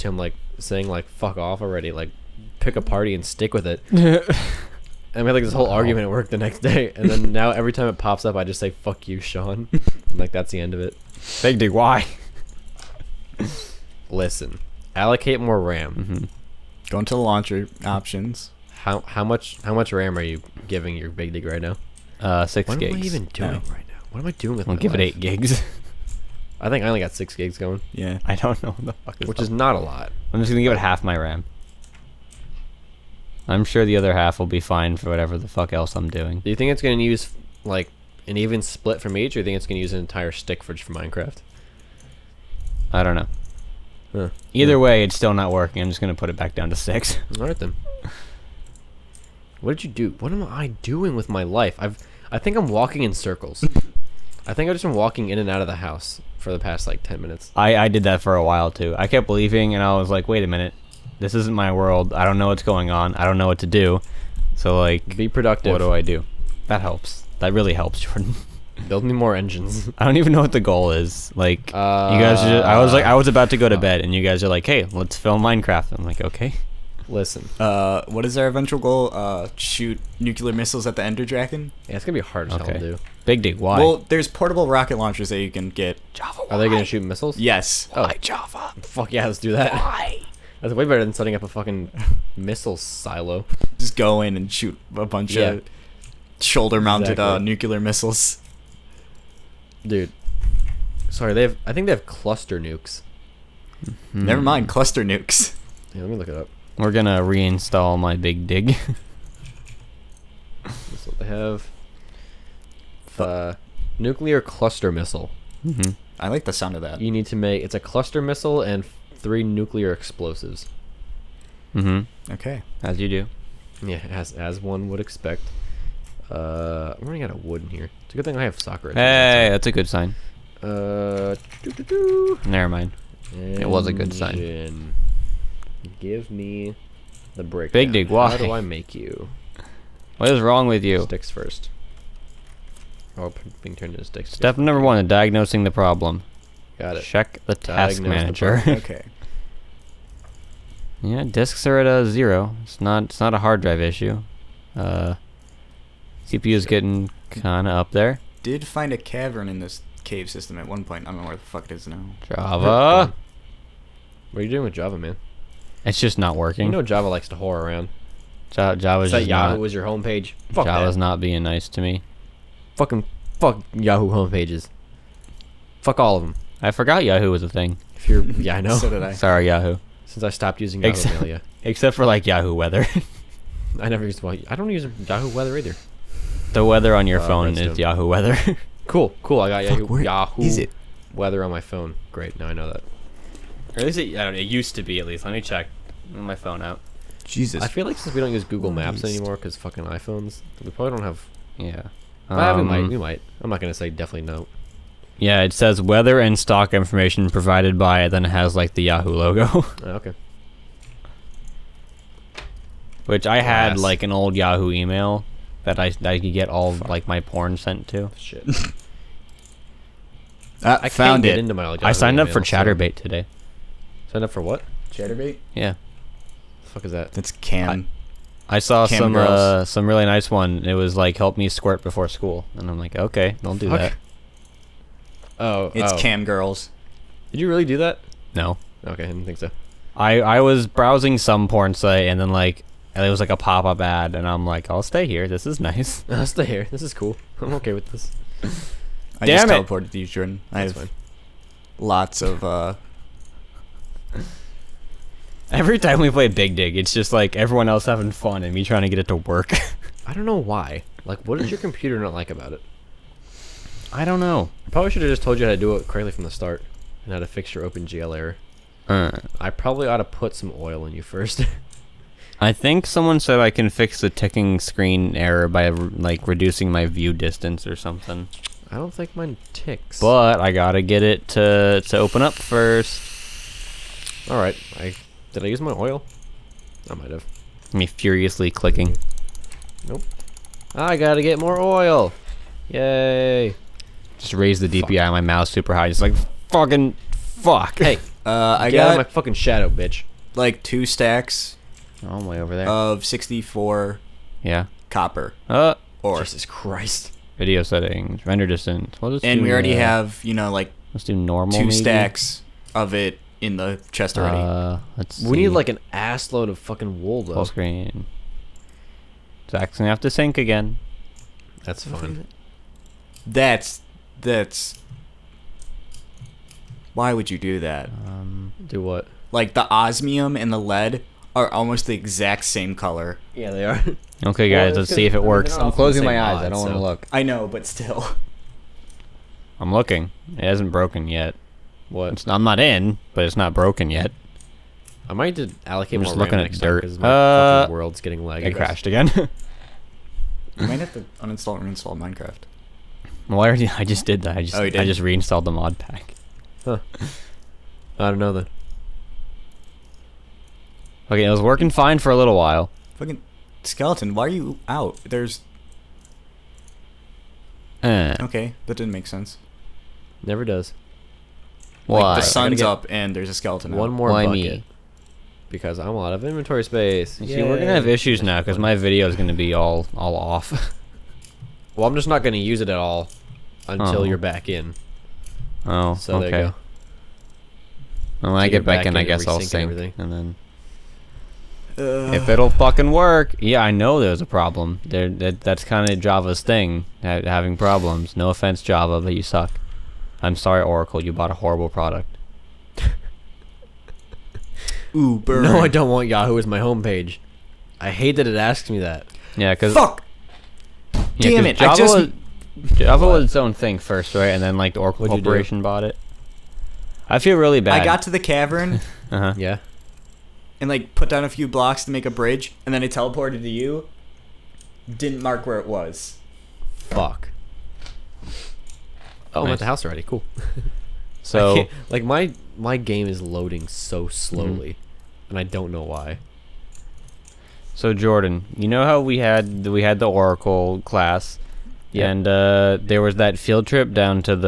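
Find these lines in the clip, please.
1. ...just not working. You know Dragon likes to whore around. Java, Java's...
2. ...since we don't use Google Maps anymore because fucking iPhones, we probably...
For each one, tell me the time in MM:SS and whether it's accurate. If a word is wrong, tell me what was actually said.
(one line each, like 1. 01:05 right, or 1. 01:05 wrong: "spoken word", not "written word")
1. 02:45 wrong: "Java", not "Dragon"
2. 03:17 right.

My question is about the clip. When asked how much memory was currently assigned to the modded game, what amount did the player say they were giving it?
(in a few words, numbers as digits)
6 gigs.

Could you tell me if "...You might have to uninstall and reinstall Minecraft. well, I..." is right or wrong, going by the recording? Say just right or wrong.
right.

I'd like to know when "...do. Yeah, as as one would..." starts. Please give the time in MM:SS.
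02:03.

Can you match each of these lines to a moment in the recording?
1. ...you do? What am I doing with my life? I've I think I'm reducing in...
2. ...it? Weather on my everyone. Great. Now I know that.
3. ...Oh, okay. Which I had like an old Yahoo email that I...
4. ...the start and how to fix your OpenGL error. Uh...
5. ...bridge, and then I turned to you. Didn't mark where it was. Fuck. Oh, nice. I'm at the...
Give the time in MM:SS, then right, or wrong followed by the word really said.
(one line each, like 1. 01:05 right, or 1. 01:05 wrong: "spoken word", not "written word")
1. 00:49 wrong: "walking", not "reducing"
2. 03:10 wrong: "phone", not "everyone"
3. 03:29 right
4. 04:26 right
5. 07:02 wrong: "teleported", not "turned".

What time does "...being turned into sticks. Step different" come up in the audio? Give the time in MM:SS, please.
02:23.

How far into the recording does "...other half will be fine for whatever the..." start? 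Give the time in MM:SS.
00:33.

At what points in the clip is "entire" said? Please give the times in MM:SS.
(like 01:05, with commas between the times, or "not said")
00:39.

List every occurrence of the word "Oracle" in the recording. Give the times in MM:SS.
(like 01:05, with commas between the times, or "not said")
06:40, 06:54, 07:20.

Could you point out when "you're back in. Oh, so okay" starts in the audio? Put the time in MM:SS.
06:24.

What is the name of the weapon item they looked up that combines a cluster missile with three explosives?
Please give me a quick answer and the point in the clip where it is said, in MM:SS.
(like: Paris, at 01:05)
nuclear cluster missile, at 01:53.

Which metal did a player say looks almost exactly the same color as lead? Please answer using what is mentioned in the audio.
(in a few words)
osmium.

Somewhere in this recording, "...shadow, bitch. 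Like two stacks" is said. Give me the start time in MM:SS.
04:59.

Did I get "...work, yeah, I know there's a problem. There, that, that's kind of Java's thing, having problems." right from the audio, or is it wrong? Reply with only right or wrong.
right.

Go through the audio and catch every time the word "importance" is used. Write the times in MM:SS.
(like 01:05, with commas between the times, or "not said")
not said.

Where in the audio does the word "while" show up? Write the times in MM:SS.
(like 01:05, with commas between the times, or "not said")
00:58, 06:02.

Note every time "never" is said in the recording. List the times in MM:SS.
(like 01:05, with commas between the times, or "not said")
01:44, 02:12, 03:03, 06:10.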